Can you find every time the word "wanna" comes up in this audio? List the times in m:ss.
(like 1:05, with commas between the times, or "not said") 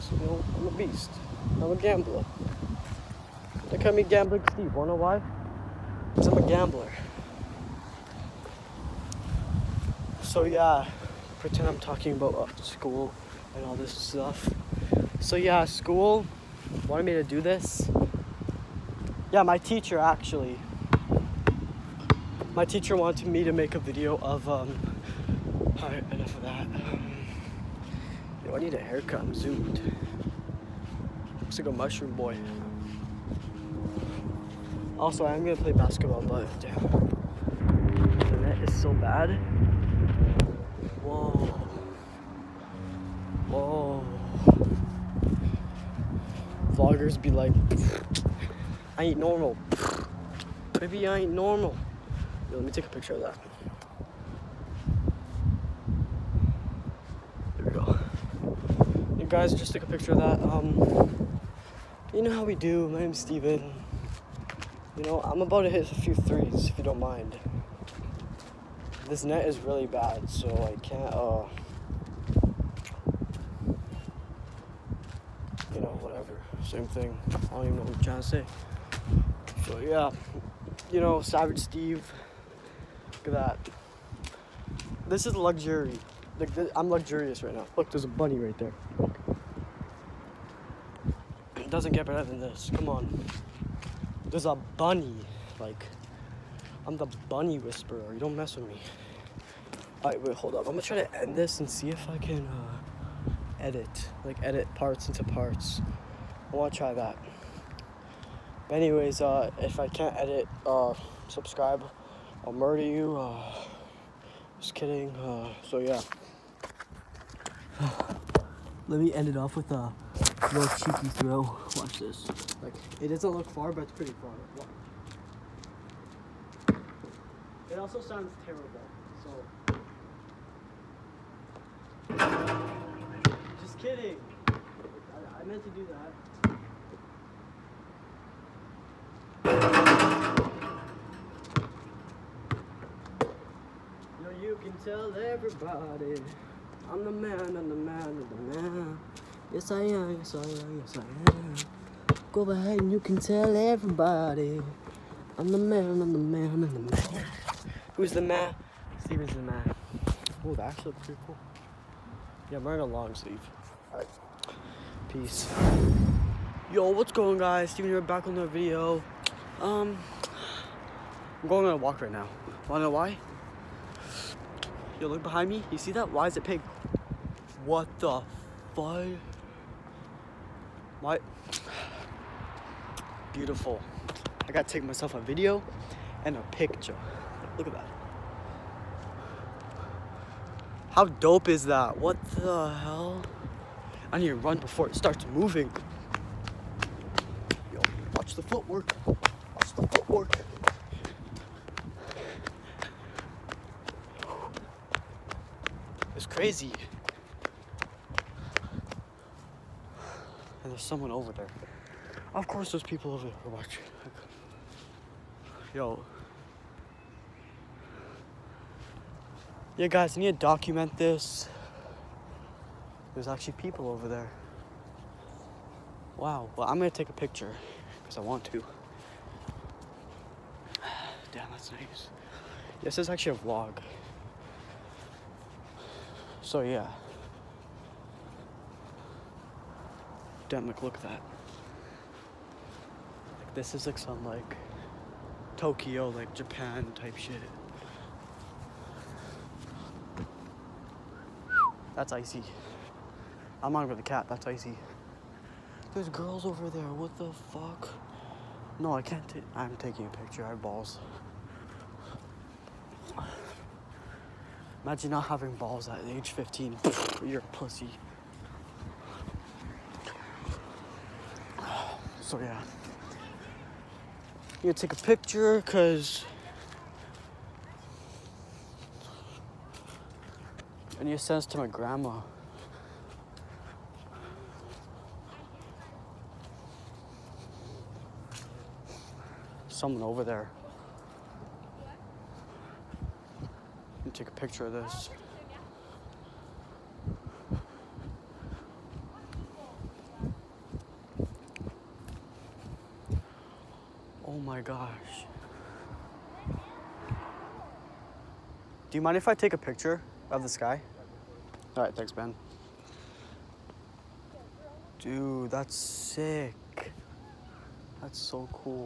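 0:04, 1:46, 2:52.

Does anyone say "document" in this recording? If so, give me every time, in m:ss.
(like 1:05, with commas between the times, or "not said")
3:40.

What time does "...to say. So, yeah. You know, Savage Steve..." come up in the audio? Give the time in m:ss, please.
1:18.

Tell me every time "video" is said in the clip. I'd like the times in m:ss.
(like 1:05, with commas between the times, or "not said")
0:23, 2:48, 3:05.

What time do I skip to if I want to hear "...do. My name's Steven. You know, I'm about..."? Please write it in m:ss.
1:02.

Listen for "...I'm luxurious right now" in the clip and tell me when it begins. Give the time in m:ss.
1:26.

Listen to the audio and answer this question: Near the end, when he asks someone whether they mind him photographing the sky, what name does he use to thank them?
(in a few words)
Ben.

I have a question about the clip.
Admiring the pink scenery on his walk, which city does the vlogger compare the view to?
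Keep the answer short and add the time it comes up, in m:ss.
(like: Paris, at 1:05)
Tokyo, at 4:05.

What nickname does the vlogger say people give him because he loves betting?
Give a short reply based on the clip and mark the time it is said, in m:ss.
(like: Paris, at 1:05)
Gambling Steve, at 0:04.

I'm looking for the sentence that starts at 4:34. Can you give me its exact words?
You take a picture cause Any sense send to my grandma.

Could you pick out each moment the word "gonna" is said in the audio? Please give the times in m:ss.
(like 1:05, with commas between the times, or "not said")
0:35, 1:40, 3:46.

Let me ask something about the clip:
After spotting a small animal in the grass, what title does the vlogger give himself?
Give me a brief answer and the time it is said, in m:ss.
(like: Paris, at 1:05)
the bunny whisperer, at 1:37.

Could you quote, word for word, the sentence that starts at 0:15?
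So yeah, school wanted me to do this.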